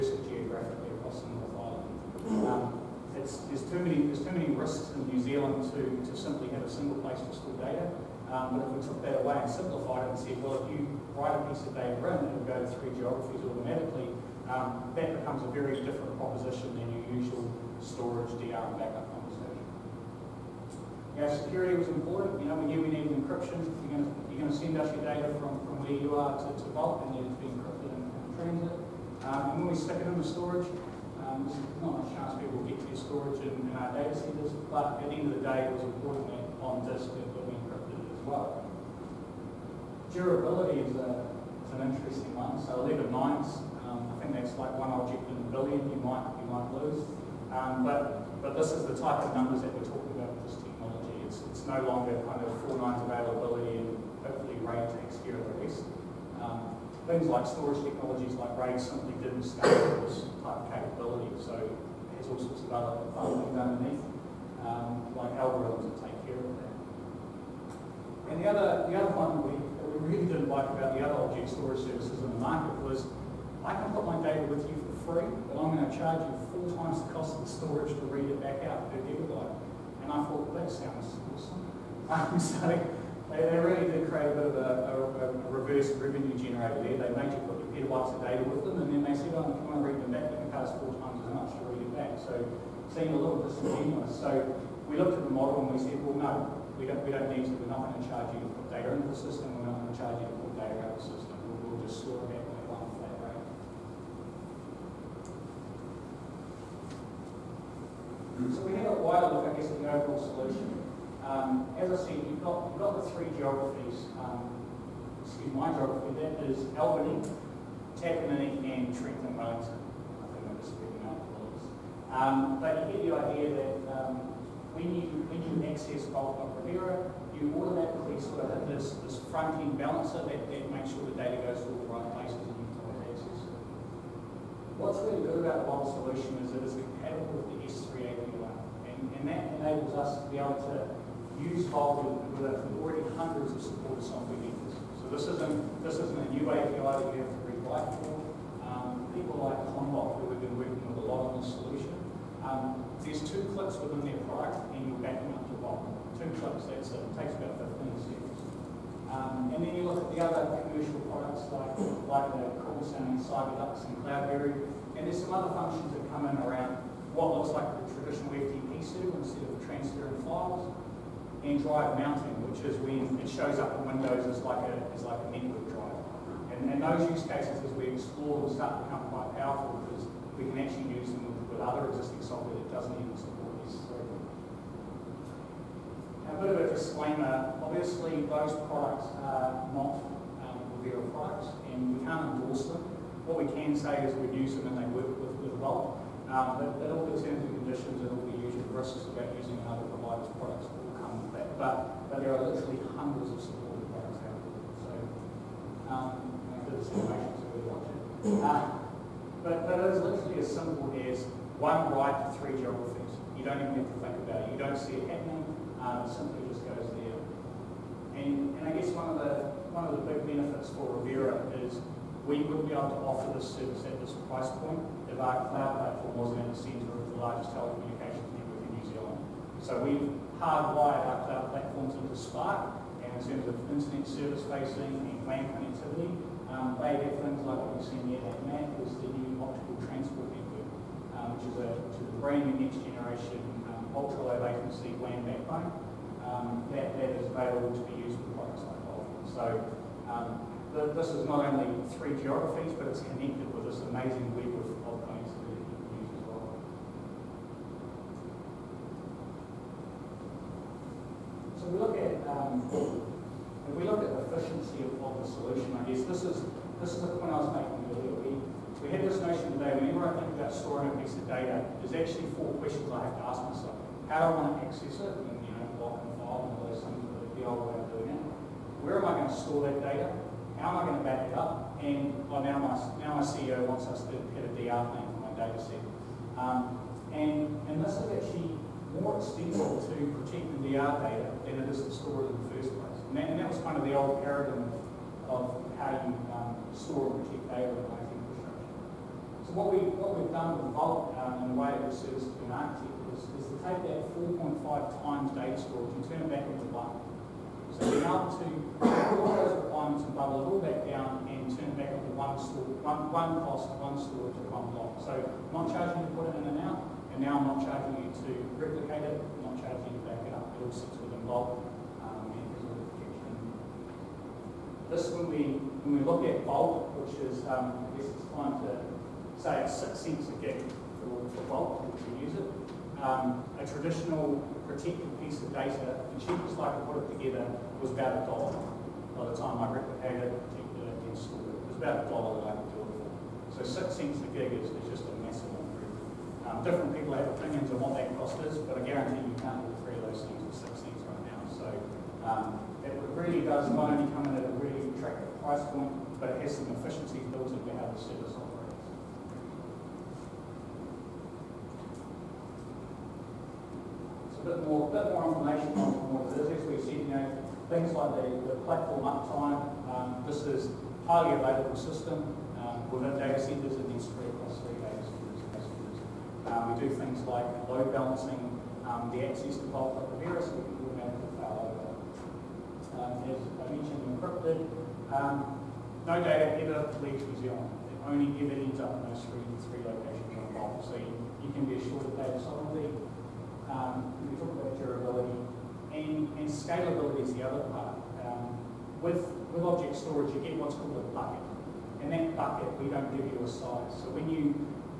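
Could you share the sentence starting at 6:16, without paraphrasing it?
Um, we do things like load balancing um, the access to Vault of the virus we can automatically fail over.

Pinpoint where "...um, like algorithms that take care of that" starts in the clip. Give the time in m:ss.
1:04.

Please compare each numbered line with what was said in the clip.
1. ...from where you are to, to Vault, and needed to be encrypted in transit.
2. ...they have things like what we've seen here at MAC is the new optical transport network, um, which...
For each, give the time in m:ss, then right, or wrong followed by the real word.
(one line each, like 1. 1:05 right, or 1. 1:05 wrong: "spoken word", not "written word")
1. 0:25 right
2. 3:56 right.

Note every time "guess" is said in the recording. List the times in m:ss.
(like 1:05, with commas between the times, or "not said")
1:49, 3:38, 4:25, 5:28.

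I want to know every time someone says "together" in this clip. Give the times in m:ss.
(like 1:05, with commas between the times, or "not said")
5:37.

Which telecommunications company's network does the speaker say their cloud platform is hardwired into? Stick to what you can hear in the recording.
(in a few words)
Spark.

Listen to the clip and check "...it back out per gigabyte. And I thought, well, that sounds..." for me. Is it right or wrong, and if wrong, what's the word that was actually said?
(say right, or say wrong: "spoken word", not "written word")
right.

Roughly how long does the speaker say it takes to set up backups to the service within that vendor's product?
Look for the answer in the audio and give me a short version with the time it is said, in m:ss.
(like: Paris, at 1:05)
15 seconds, at 2:37.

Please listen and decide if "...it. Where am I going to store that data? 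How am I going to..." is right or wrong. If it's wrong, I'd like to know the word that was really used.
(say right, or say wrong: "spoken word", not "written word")
right.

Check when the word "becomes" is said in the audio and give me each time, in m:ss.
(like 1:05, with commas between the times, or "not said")
0:15, 2:58.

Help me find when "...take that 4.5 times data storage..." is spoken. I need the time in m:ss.
5:03.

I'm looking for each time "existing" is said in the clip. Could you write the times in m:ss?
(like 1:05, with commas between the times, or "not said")
3:01.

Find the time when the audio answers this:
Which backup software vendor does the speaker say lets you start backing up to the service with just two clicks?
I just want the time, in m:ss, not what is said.
2:29.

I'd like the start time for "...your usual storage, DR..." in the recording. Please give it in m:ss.
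0:16.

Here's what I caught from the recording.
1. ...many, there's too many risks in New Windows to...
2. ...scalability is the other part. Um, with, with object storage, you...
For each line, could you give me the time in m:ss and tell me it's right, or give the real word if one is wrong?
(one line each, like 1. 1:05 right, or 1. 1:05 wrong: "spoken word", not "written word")
1. 0:03 wrong: "Zealand", not "Windows"
2. 6:36 right.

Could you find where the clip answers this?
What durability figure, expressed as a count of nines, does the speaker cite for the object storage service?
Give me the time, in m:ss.
0:42.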